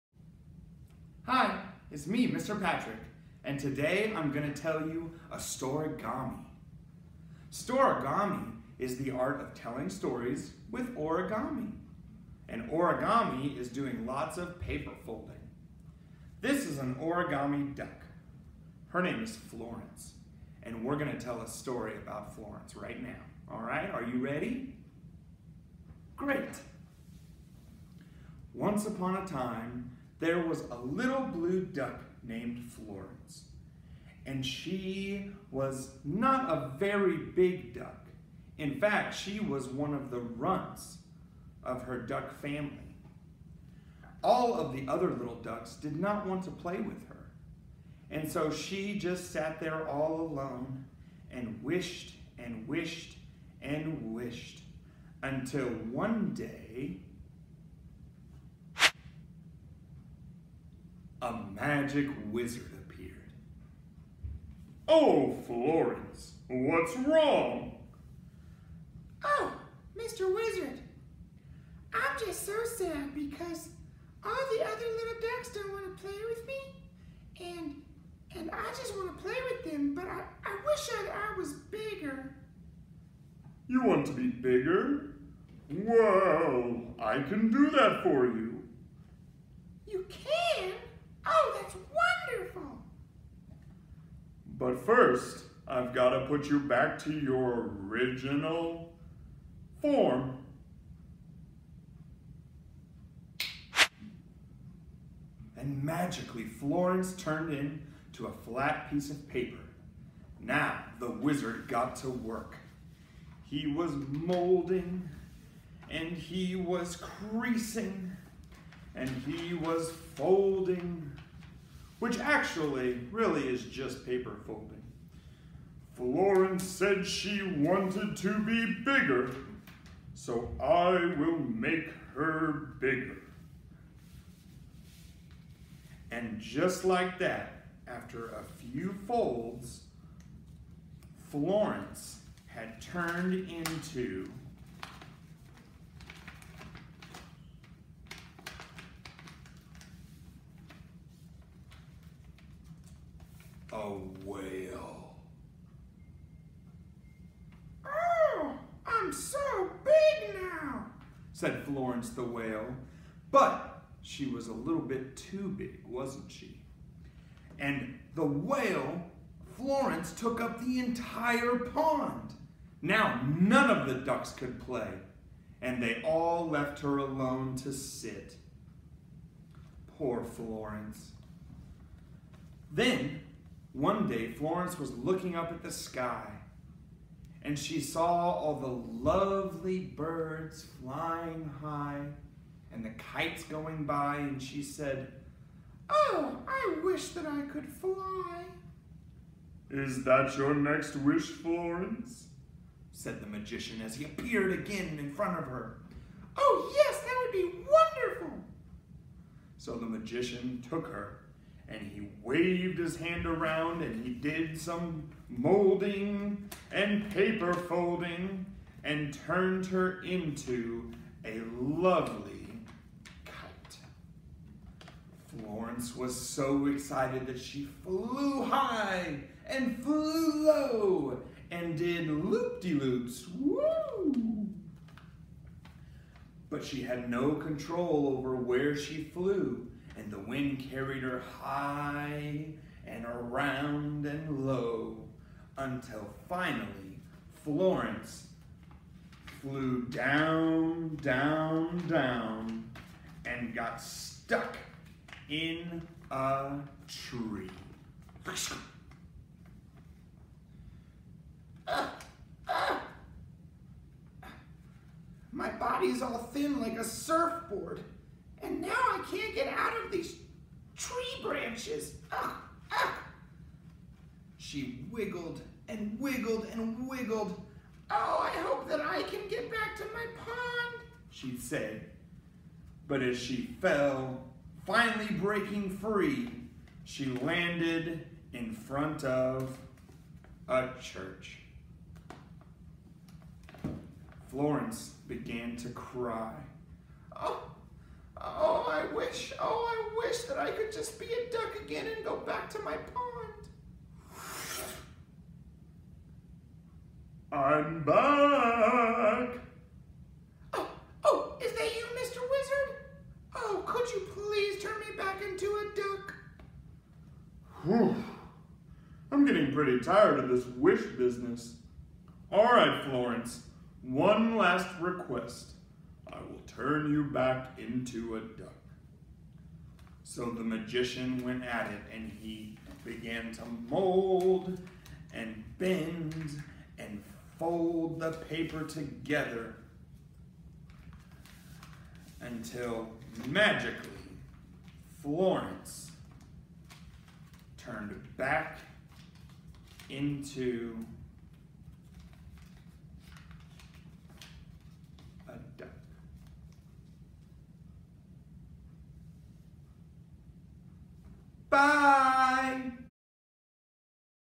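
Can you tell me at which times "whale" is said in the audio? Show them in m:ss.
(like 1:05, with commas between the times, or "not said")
2:34, 2:42, 2:48.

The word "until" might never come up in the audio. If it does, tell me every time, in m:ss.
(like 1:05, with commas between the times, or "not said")
0:55, 4:05, 5:42.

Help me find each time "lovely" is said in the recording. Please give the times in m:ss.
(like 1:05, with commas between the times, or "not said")
3:09, 3:41.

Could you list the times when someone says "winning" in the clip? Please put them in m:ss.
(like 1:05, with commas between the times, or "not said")
not said.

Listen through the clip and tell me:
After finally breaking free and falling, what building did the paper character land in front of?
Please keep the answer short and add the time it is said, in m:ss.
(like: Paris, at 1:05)
church, at 4:50.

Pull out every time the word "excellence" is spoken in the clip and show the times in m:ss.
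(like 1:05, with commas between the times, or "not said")
not said.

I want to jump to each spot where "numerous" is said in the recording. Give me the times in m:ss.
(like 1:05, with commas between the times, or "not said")
not said.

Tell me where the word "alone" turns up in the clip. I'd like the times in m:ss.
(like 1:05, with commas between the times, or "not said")
0:50, 2:56.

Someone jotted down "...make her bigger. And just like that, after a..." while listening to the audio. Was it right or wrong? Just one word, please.
right.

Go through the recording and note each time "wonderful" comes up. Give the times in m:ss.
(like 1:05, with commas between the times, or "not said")
3:27.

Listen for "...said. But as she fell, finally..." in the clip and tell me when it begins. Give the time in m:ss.
4:41.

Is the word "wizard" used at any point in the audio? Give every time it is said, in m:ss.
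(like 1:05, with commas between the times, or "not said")
1:02, 1:10, 1:51, 5:12.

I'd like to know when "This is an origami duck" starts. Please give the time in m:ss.
0:16.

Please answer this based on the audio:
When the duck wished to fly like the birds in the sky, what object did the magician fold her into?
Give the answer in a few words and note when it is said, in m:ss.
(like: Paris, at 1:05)
kite, at 3:43.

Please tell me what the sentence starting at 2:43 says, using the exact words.
But she was a little bit too big, wasn't she?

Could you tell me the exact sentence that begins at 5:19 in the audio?
I'm getting pretty tired of this wish business.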